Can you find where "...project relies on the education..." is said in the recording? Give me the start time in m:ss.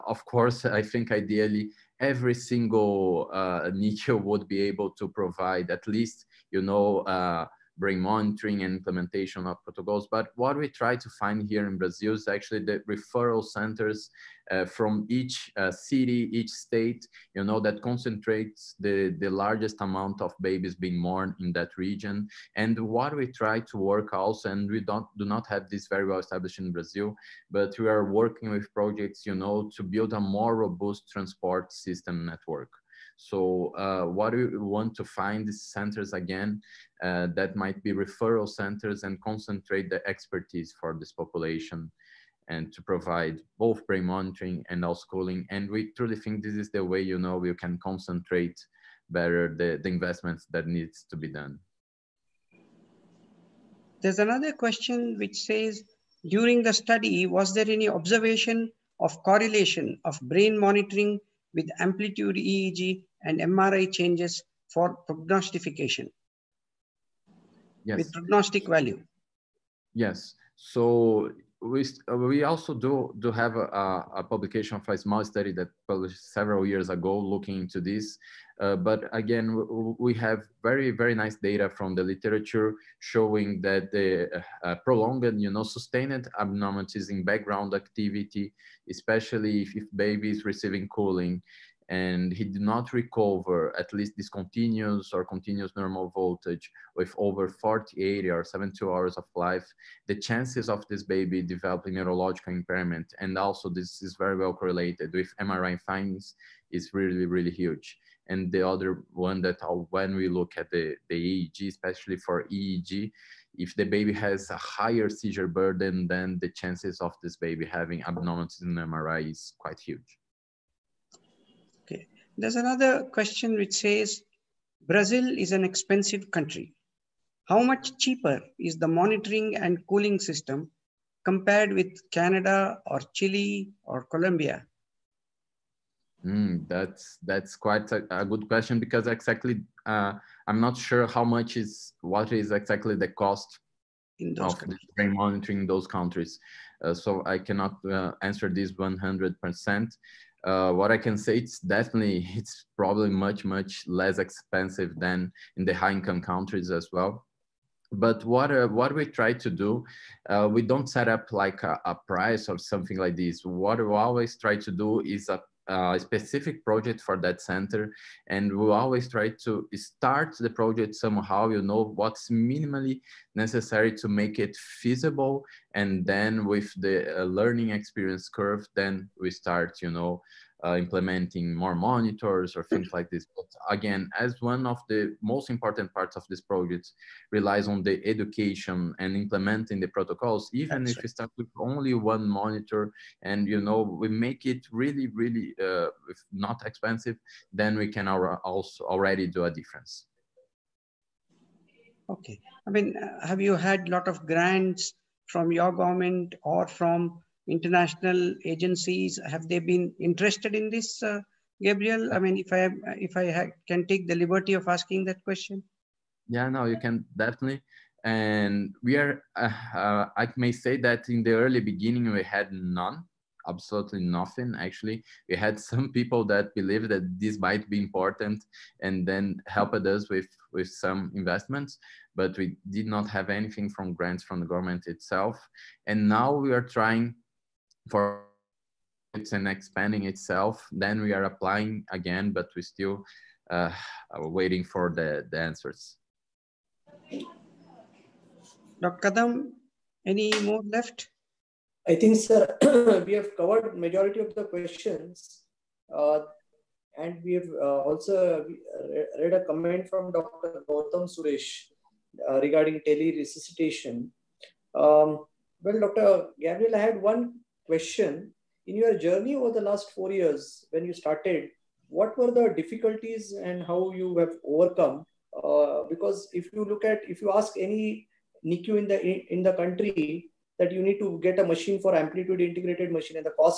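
3:06.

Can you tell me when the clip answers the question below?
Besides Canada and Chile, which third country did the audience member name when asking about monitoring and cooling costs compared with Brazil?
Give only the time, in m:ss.
2:14.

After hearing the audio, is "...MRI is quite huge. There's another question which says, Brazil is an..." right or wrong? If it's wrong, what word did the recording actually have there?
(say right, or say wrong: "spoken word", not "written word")
right.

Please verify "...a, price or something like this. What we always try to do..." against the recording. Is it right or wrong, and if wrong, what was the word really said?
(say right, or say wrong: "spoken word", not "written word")
right.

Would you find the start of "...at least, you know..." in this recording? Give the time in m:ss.
0:05.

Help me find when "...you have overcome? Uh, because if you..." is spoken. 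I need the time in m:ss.
4:33.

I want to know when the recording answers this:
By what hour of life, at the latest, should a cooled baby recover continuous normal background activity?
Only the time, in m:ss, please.
1:38.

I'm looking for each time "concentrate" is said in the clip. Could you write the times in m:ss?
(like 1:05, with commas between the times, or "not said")
0:17, 0:39, 0:47.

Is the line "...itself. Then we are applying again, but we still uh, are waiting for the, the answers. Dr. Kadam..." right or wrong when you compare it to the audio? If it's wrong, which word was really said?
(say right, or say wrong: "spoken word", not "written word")
right.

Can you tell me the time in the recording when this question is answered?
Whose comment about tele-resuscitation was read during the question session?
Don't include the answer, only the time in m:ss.
4:20.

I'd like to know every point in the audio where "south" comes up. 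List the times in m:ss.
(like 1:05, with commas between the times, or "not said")
not said.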